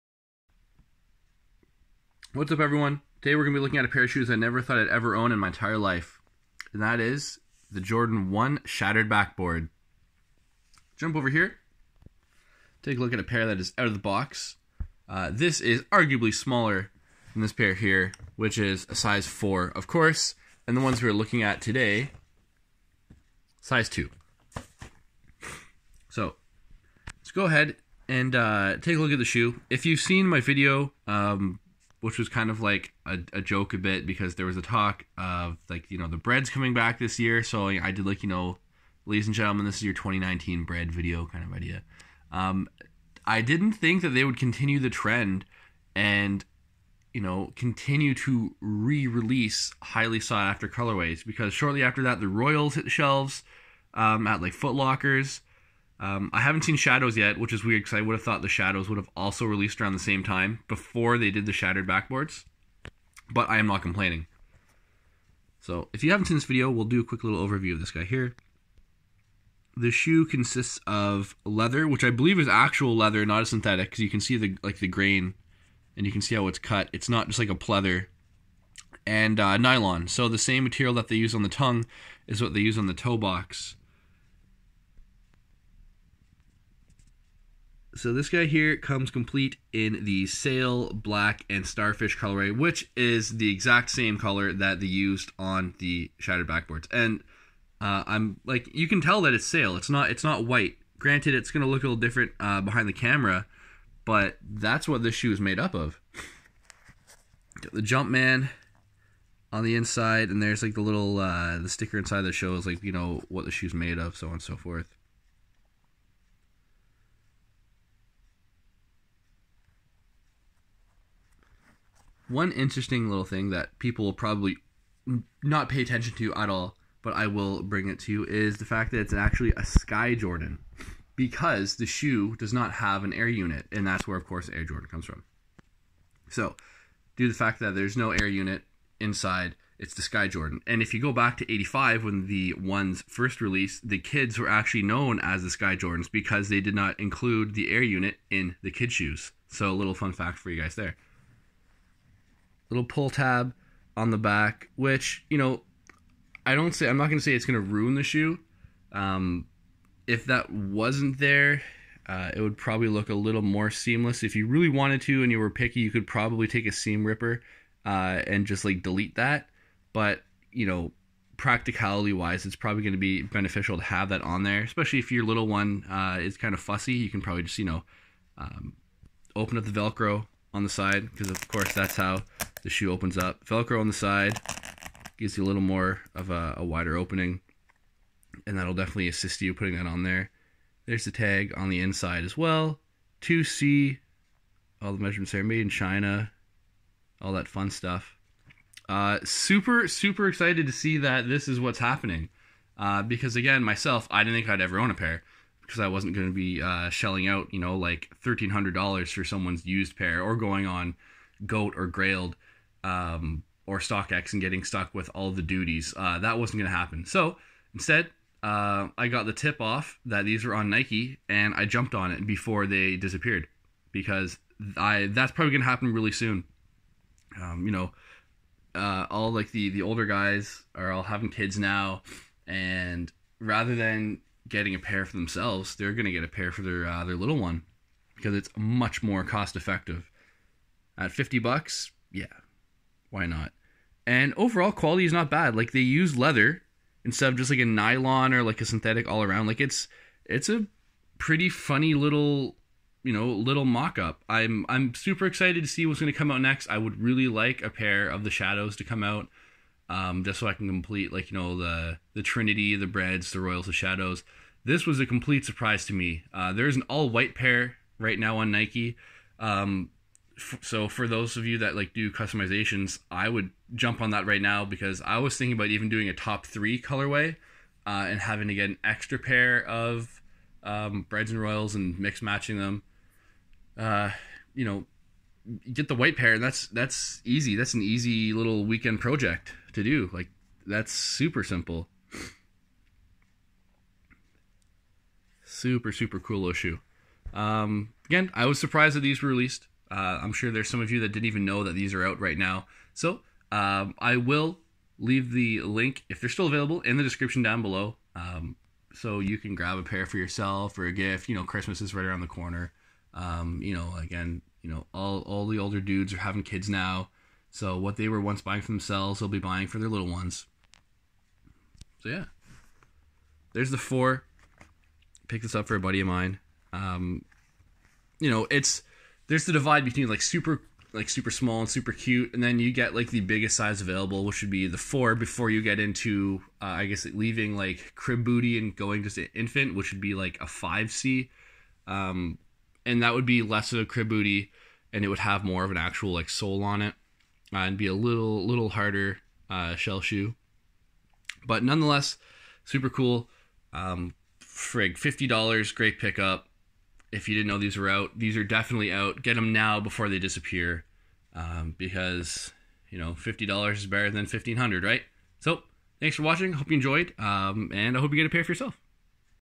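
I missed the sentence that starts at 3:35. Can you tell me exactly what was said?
Uh, that wasn't going to happen.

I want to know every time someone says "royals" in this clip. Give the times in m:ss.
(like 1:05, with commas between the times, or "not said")
0:52, 4:23, 4:41.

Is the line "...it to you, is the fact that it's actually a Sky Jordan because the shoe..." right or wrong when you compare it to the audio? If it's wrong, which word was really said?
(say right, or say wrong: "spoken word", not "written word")
right.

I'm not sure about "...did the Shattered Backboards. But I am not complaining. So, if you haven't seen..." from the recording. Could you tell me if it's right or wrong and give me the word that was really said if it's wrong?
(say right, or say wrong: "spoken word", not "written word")
right.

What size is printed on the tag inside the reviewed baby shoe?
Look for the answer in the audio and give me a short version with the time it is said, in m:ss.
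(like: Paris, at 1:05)
2C, at 3:13.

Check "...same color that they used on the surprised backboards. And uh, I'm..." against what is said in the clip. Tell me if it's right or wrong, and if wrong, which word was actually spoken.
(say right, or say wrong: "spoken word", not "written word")
wrong: "shattered", not "surprised".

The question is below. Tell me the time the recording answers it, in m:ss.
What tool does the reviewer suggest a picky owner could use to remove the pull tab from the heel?
2:46.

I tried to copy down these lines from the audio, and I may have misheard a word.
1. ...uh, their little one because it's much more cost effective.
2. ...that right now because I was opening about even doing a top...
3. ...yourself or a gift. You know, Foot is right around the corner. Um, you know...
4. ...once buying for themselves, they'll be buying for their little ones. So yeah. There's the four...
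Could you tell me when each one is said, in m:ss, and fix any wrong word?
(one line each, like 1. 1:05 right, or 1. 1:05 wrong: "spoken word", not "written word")
1. 3:56 right
2. 4:34 wrong: "thinking", not "opening"
3. 5:10 wrong: "Christmas", not "Foot"
4. 5:18 right.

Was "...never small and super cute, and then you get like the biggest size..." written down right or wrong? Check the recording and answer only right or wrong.
wrong.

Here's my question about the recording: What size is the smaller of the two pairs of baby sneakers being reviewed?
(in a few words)
2.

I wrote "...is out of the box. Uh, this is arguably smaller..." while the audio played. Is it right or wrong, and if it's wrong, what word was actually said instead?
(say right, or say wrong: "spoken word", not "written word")
right.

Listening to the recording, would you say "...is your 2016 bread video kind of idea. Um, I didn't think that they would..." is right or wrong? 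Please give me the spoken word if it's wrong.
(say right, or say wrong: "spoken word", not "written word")
wrong: "2019", not "2016".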